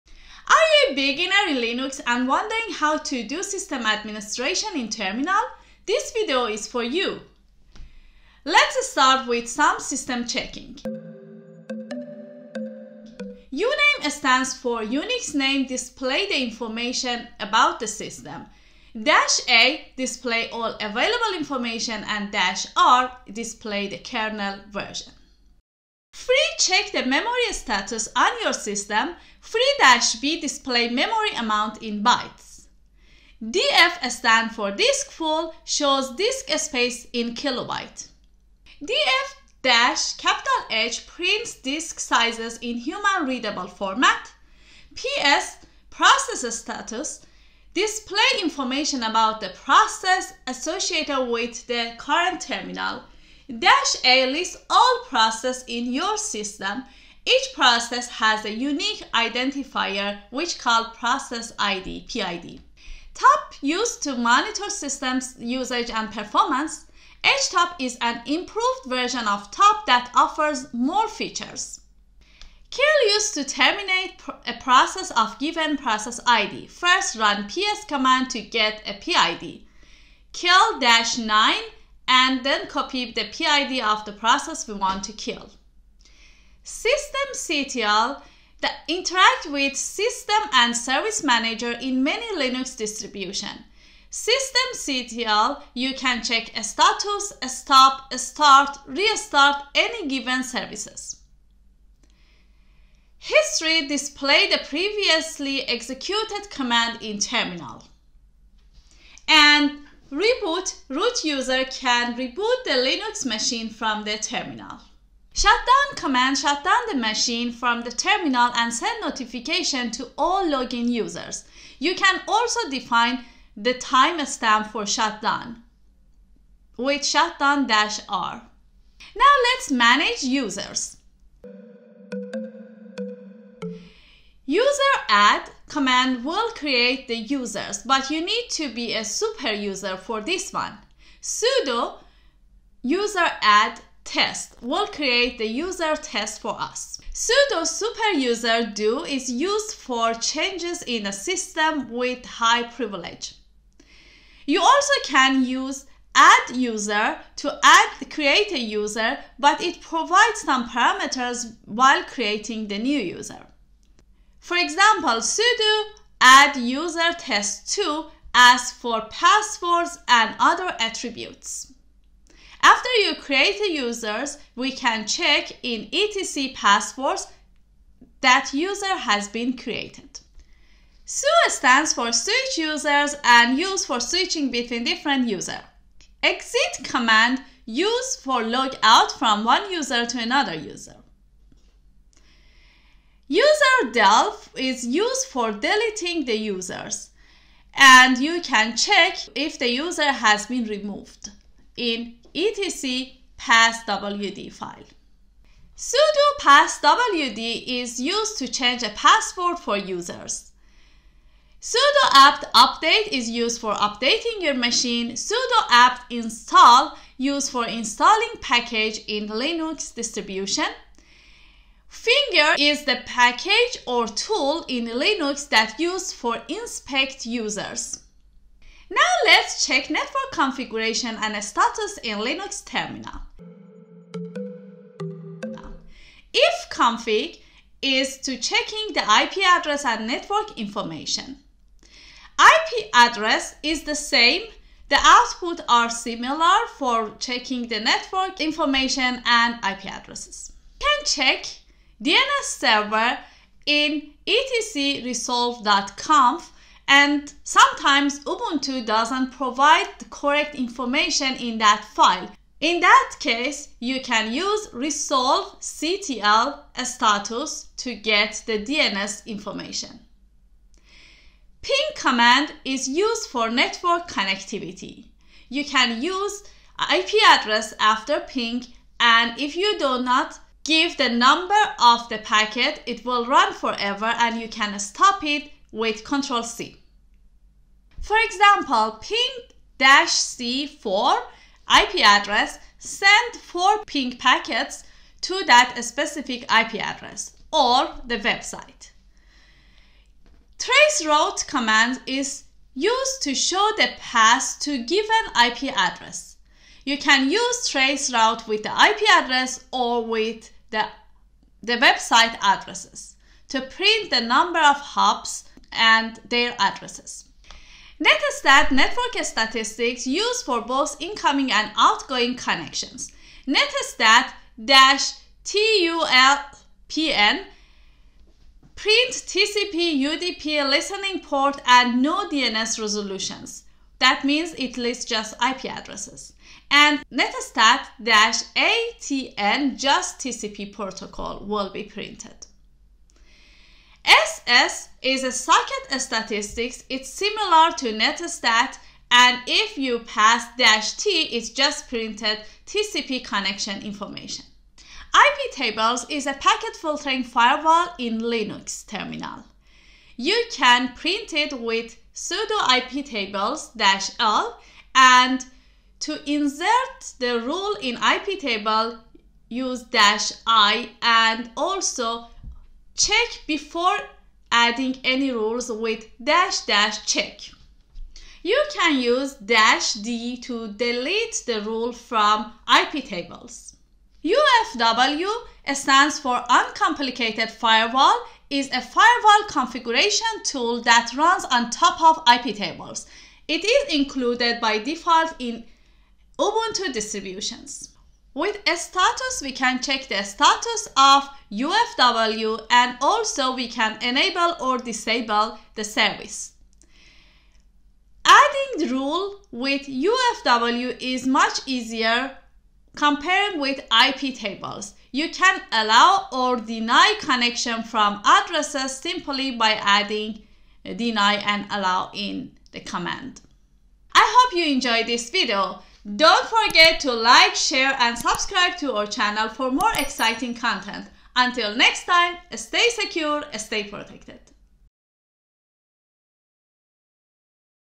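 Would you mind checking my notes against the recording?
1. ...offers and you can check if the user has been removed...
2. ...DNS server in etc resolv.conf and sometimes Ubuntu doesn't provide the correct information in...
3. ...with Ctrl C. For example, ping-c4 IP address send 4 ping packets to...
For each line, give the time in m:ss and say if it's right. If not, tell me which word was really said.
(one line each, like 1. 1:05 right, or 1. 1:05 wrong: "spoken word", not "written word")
1. 3:16 wrong: "users", not "offers"
2. 4:12 right
3. 4:45 right.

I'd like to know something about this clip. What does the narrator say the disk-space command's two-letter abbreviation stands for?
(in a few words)
disk full.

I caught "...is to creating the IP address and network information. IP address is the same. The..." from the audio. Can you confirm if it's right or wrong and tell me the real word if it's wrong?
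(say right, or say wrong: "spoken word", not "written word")
wrong: "checking", not "creating".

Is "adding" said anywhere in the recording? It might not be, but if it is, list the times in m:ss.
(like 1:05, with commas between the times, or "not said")
6:14, 6:48, 6:59.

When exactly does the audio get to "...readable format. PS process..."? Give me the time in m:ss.
0:43.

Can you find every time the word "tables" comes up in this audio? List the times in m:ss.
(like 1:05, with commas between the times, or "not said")
5:55, 6:03, 6:08, 6:23, 6:32, 6:54.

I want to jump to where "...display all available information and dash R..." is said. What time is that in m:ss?
0:19.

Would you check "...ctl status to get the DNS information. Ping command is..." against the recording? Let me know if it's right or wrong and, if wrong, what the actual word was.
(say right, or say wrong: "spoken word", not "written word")
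right.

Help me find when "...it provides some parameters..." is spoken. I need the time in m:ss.
2:39.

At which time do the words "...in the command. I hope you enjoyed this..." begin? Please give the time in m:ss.
7:02.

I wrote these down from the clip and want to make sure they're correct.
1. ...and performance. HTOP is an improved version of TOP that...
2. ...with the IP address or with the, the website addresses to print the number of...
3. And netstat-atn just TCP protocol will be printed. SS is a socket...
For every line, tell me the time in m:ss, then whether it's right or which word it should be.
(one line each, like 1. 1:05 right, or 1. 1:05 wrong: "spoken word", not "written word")
1. 1:05 right
2. 5:08 right
3. 5:36 right.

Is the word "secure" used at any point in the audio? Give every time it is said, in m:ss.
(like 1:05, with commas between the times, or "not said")
7:12.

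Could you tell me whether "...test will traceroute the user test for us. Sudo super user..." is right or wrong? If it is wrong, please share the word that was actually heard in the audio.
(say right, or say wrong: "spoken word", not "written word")
wrong: "create", not "traceroute".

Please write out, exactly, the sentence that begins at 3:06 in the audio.
Exit command used for log out from one user to another user.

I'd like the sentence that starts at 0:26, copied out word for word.
Free check the memory status on your system.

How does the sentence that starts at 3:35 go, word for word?
sudo apt install used for installing package in Linux distribution.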